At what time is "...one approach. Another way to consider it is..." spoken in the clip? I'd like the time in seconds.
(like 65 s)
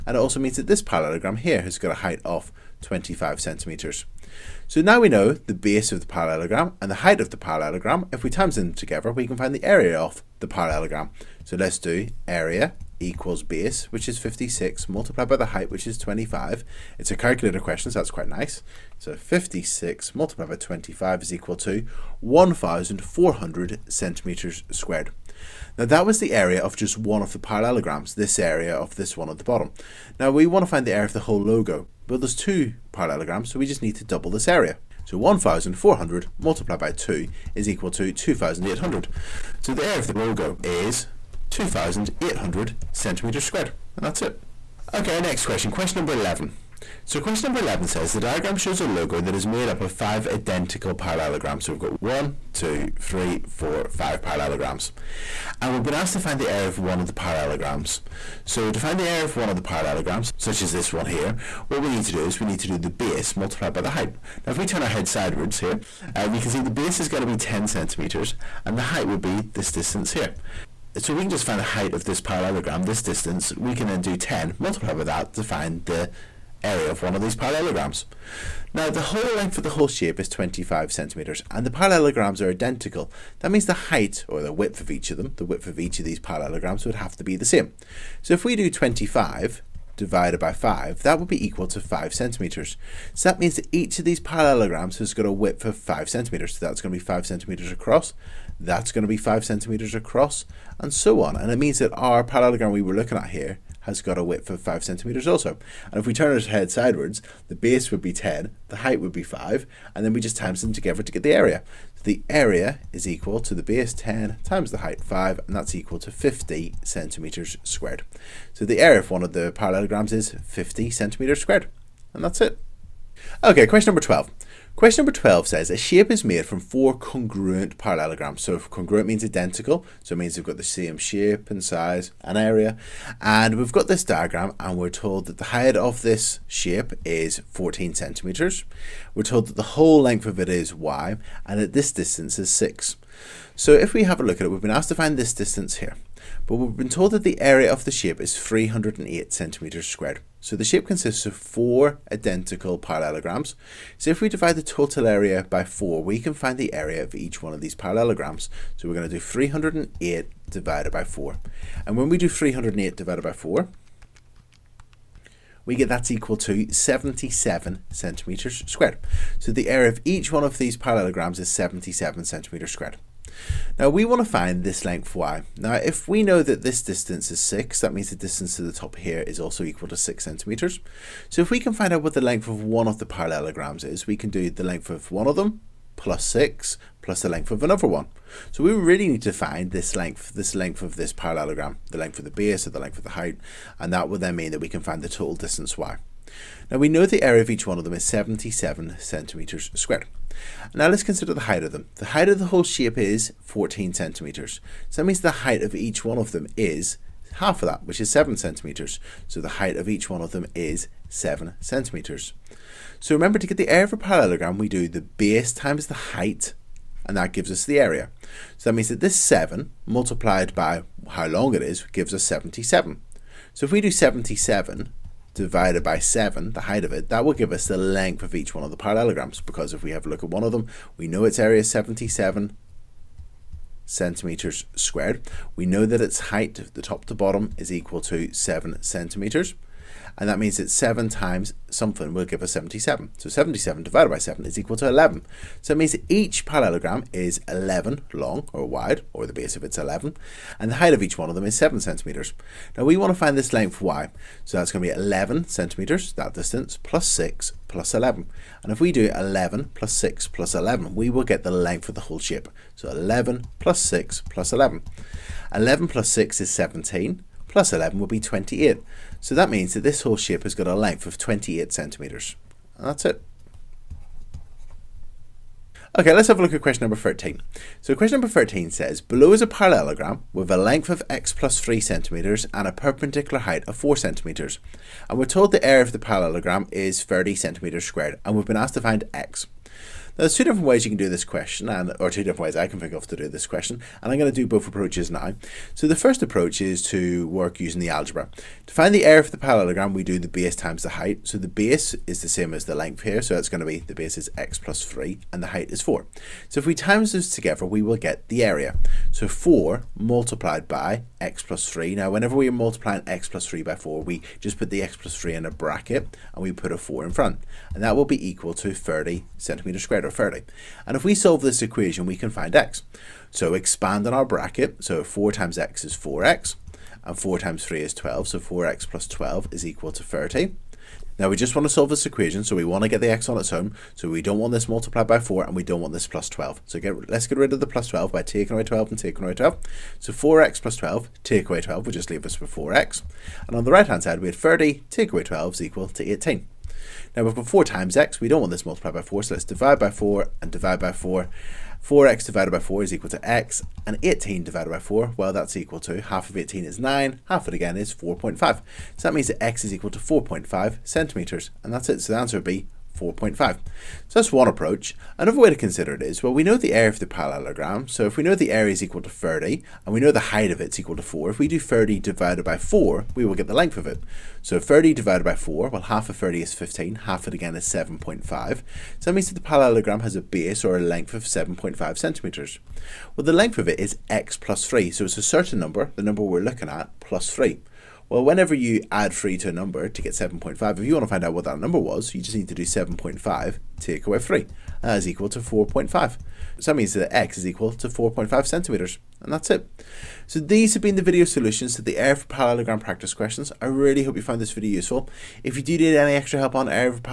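364 s.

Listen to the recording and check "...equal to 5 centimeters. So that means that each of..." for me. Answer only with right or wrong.
right.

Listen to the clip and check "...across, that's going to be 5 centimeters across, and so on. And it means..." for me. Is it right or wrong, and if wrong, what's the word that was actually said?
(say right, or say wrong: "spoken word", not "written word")
right.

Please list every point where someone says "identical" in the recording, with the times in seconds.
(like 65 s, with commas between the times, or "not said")
50 s, 82 s, 129 s, 152 s.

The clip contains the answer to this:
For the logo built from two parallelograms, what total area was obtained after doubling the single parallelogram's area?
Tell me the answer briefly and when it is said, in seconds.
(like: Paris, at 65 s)
2,800 cm², at 41 s.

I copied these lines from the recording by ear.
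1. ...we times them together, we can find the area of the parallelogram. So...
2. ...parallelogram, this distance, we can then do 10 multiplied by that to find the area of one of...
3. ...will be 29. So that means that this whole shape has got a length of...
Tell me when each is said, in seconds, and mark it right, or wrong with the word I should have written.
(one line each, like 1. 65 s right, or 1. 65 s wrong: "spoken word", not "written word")
1. 8 s right
2. 72 s right
3. 267 s wrong: "28", not "29".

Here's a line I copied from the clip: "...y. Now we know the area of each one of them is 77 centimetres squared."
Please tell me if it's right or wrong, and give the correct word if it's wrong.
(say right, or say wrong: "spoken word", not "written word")
right.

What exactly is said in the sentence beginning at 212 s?
So remember to get the area of a parallelogram, we do the base times the height, and that gives us the area.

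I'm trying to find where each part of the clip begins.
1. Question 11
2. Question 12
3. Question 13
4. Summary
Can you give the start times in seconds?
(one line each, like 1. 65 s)
1. 44 s
2. 122 s
3. 275 s
4. 398 s.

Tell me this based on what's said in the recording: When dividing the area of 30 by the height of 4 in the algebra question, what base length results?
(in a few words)
7.5 cm.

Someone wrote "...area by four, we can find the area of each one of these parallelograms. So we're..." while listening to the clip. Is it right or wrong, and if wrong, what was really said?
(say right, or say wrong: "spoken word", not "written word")
right.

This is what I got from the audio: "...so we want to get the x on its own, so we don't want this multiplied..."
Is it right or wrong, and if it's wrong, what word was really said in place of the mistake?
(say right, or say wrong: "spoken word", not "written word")
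right.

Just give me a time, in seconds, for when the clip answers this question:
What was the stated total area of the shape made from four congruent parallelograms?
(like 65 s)
148 s.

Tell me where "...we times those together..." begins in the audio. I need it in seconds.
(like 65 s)
306 s.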